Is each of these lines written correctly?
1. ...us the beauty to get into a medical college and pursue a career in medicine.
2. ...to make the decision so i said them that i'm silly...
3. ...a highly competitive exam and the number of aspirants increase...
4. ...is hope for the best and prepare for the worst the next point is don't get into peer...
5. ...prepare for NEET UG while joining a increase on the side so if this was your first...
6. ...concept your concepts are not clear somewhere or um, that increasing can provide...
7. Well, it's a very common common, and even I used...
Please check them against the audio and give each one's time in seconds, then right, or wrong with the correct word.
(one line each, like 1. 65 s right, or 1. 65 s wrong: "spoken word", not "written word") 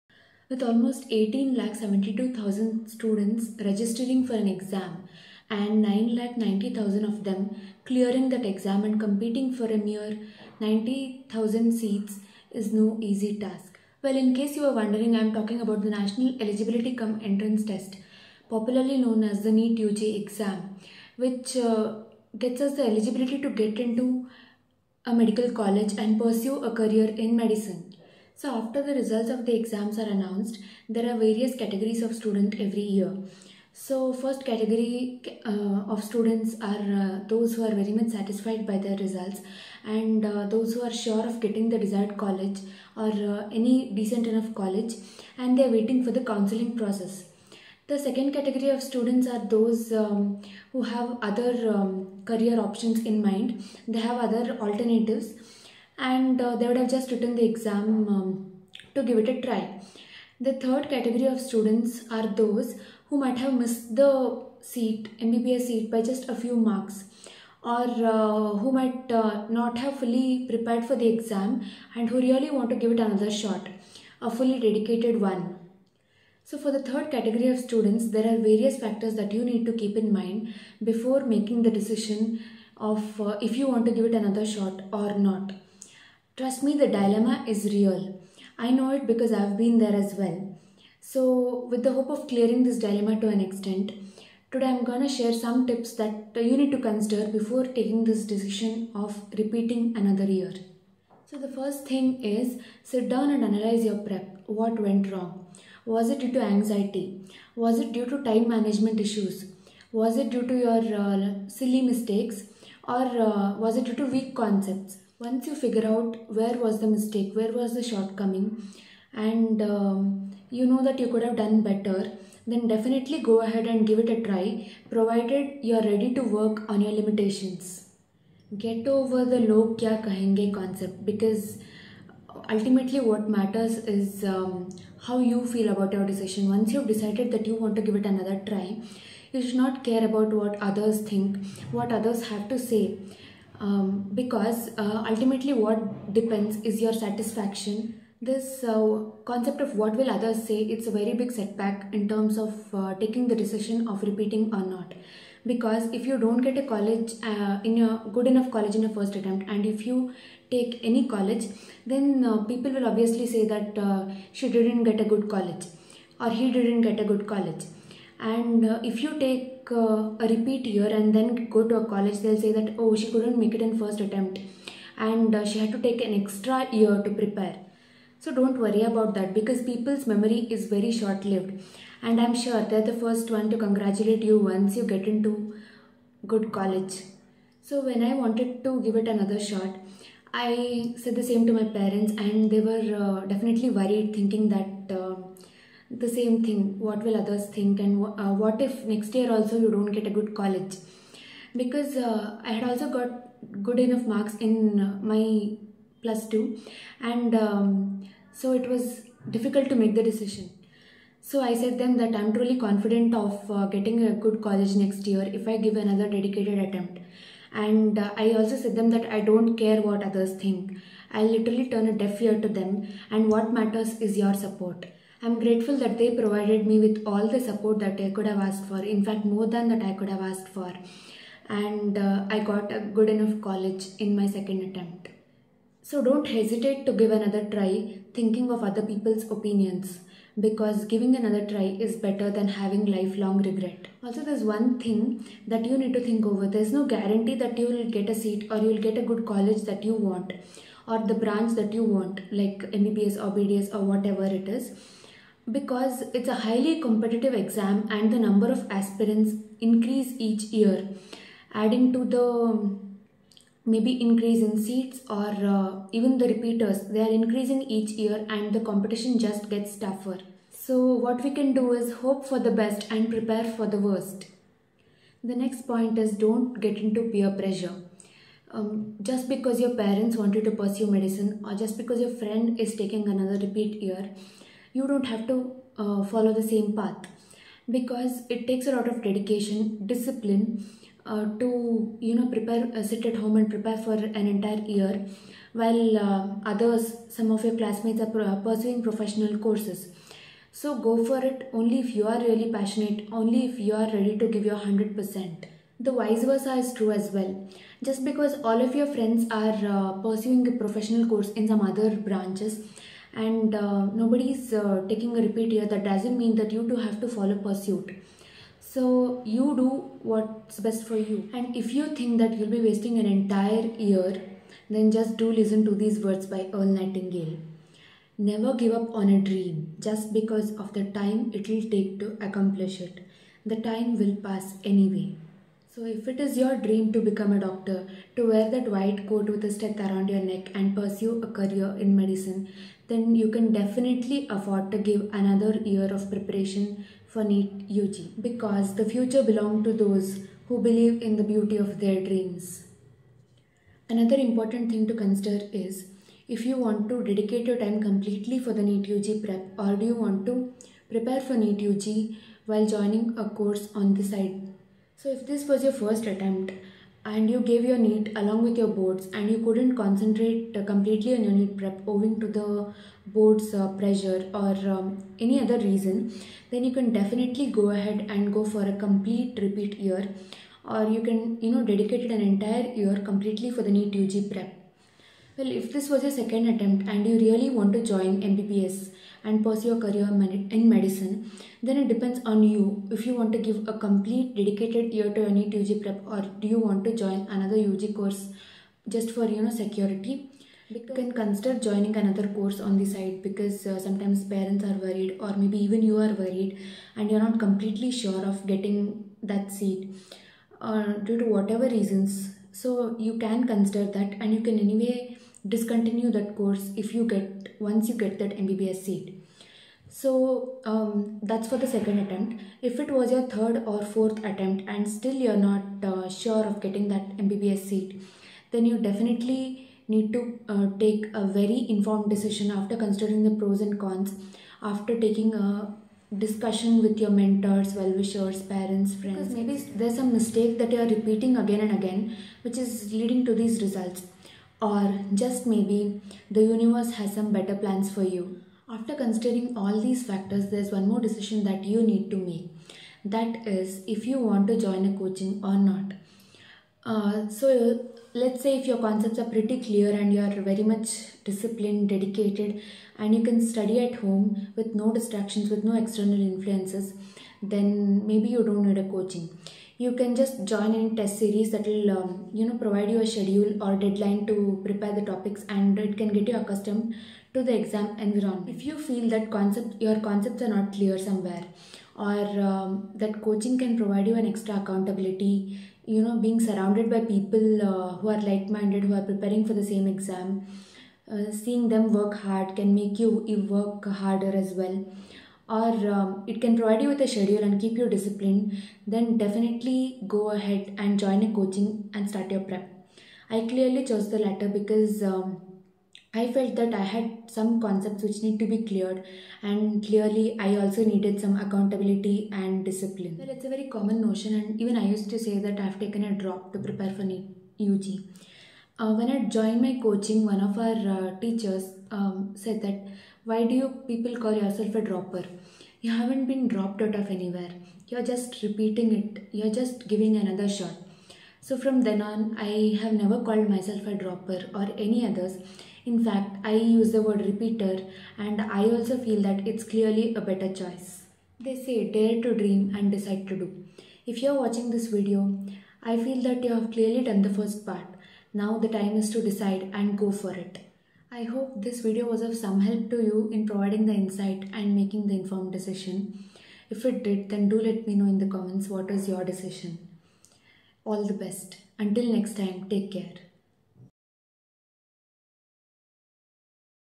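1. 22 s wrong: "eligibility", not "beauty"
2. 209 s wrong: "truly", not "silly"
3. 256 s right
4. 271 s right
5. 360 s wrong: "course", not "increase"
6. 479 s wrong: "coaching", not "increasing"
7. 513 s wrong: "notion", not "common".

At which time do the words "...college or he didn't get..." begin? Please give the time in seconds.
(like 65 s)
165 s.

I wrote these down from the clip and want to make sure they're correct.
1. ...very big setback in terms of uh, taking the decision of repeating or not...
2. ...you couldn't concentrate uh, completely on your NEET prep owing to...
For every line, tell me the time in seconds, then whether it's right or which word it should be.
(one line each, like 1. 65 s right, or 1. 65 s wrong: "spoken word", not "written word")
1. 150 s right
2. 369 s right.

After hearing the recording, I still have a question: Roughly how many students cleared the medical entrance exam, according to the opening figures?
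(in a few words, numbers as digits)
9 lakh 90,000.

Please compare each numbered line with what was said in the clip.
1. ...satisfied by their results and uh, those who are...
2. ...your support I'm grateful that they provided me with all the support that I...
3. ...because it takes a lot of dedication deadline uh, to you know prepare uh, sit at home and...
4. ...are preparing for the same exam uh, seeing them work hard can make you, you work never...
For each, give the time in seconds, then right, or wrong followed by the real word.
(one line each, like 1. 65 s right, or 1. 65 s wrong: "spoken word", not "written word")
1. 38 s right
2. 224 s right
3. 287 s wrong: "discipline", not "deadline"
4. 488 s wrong: "harder", not "never".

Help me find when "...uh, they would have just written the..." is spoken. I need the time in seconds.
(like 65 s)
56 s.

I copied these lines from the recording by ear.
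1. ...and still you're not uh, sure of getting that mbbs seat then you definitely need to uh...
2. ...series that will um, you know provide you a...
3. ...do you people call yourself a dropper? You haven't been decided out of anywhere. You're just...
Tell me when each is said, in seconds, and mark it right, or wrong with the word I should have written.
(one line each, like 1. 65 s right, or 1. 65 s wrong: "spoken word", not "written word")
1. 424 s right
2. 471 s right
3. 523 s wrong: "dropped", not "decided".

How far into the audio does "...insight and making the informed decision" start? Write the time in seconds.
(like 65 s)
553 s.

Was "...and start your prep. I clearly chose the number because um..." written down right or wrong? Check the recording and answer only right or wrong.
wrong.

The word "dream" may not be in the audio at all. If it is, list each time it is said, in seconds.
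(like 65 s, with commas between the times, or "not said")
329 s, 336 s, 352 s, 542 s.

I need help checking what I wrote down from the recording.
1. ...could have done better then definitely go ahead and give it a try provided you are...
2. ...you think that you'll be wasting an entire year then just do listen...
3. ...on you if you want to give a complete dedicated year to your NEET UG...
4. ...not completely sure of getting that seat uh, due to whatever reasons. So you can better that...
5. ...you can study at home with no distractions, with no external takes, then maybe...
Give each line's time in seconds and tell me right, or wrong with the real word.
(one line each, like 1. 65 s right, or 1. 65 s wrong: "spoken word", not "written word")
1. 121 s right
2. 321 s right
3. 392 s right
4. 407 s wrong: "consider", not "better"
5. 463 s wrong: "influences", not "takes".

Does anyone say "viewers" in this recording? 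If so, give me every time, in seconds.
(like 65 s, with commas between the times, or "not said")
not said.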